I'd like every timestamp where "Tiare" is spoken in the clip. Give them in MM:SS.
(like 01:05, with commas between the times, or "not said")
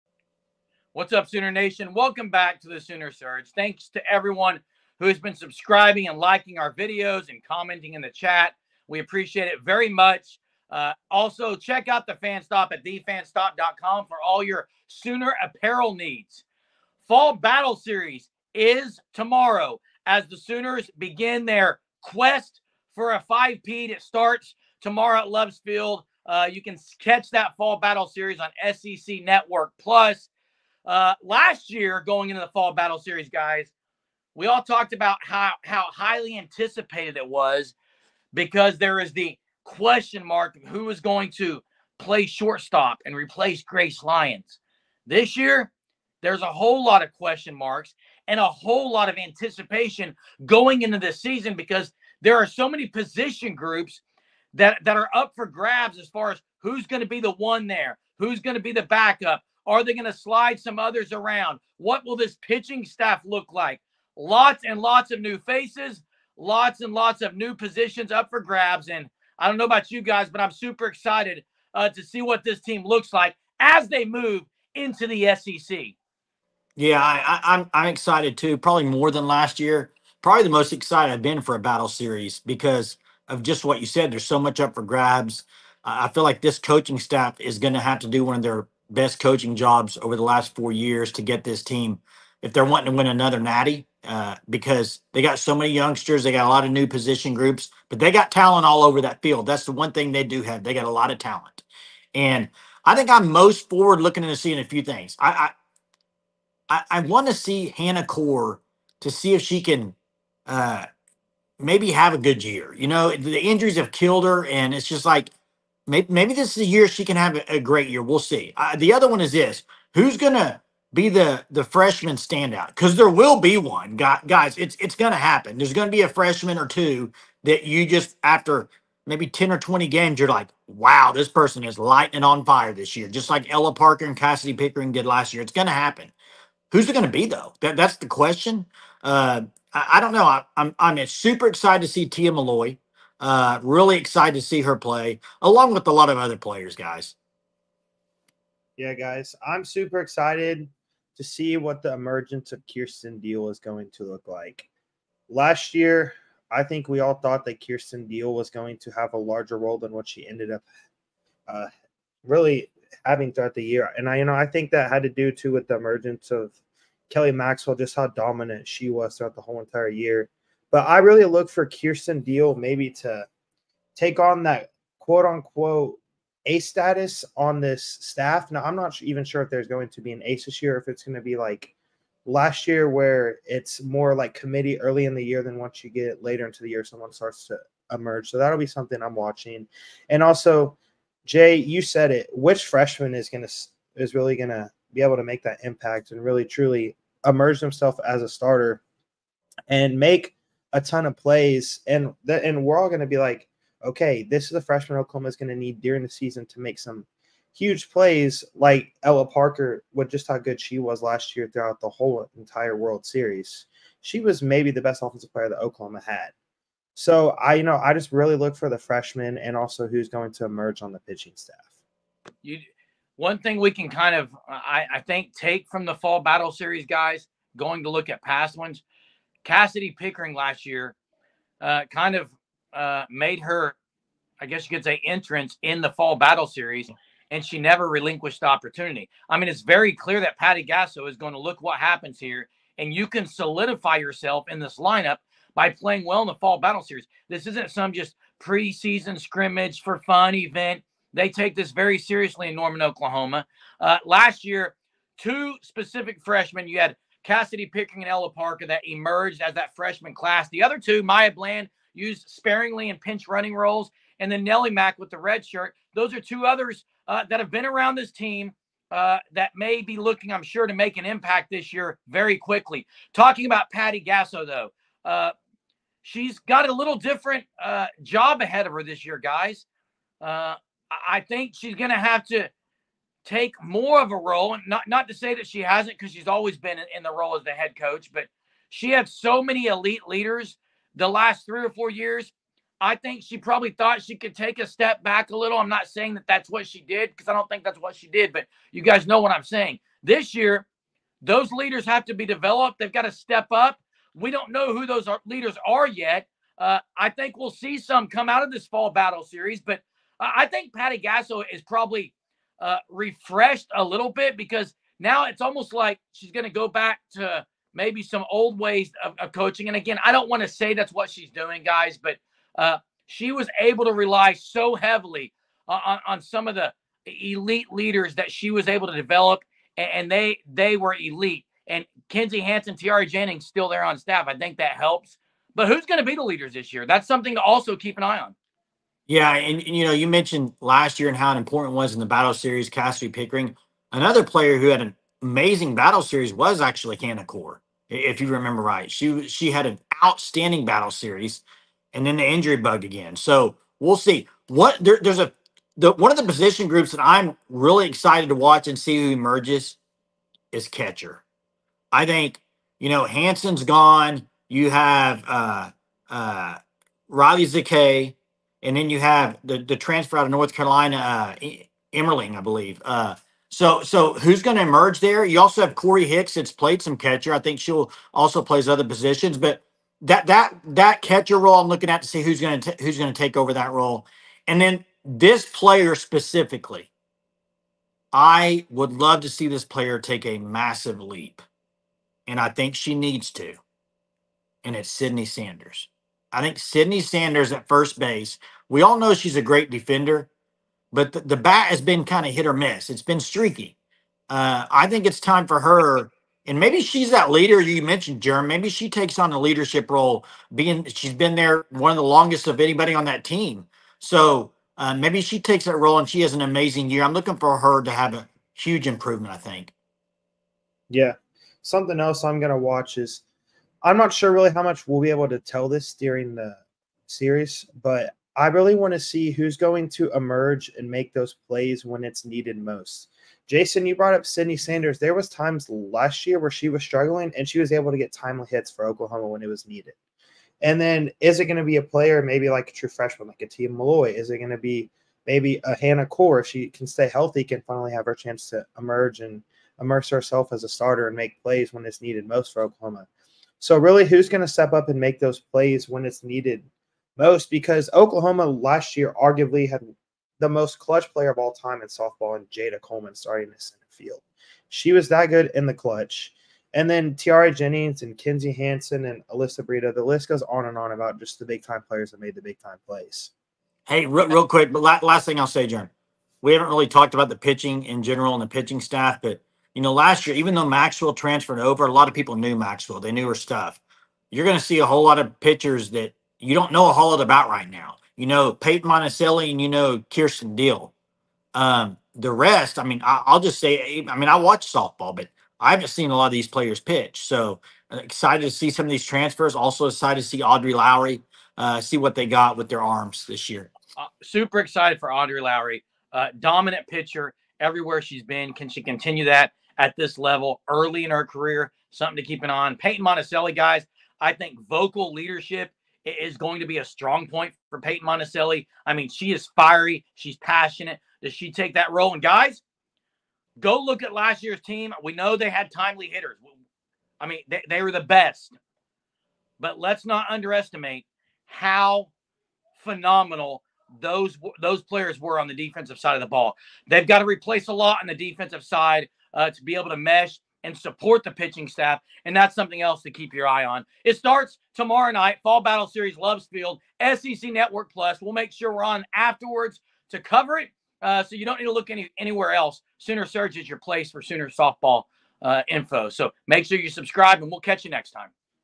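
05:32, 07:47.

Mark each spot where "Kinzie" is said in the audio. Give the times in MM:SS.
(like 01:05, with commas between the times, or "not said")
05:32, 07:48.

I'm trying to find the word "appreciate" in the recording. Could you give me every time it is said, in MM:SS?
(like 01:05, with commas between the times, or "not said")
00:08.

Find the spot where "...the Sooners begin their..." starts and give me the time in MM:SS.
00:20.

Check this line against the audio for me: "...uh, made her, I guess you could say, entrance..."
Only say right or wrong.
right.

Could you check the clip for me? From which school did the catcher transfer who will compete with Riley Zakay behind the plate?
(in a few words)
North Carolina.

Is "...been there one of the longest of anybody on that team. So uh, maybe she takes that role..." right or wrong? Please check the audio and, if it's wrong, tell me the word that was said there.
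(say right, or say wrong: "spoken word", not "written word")
right.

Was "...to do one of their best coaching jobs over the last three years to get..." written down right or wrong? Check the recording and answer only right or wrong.
wrong.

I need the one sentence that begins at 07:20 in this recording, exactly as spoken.
And then is it going to be a player, maybe like a true freshman, like a Milloy?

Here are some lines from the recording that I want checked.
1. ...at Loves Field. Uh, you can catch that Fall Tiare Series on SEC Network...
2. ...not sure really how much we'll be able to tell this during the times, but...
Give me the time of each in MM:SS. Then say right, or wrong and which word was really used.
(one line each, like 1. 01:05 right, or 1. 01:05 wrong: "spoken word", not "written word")
1. 00:25 wrong: "Battle", not "Tiare"
2. 07:03 wrong: "series", not "times".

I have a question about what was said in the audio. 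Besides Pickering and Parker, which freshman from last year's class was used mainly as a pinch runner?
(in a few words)
Maya Bland.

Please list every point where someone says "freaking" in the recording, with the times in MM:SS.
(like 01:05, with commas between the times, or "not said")
not said.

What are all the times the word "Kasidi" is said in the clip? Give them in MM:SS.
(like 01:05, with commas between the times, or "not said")
02:14, 03:49, 04:17, 05:42.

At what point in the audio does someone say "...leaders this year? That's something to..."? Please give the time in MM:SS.
05:36.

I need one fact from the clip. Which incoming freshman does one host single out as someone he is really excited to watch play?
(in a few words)
Tia Milloy.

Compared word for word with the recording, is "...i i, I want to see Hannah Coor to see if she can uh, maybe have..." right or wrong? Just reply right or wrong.
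right.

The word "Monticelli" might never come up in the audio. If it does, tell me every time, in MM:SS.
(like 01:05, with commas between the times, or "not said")
08:08, 08:32, 08:38.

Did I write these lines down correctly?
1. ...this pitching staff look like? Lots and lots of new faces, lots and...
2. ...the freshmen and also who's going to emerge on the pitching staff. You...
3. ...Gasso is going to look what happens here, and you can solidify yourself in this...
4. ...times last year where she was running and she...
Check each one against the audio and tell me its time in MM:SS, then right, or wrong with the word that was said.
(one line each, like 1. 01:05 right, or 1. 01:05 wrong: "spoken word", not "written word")
1. 01:02 right
2. 03:38 right
3. 04:00 right
4. 07:15 wrong: "struggling", not "running".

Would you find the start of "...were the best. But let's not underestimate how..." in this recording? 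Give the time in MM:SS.
08:47.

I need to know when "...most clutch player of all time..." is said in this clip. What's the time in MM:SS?
07:40.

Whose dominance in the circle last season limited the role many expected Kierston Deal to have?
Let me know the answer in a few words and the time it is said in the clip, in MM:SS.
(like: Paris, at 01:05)
Kelly Maxwell, at 02:47.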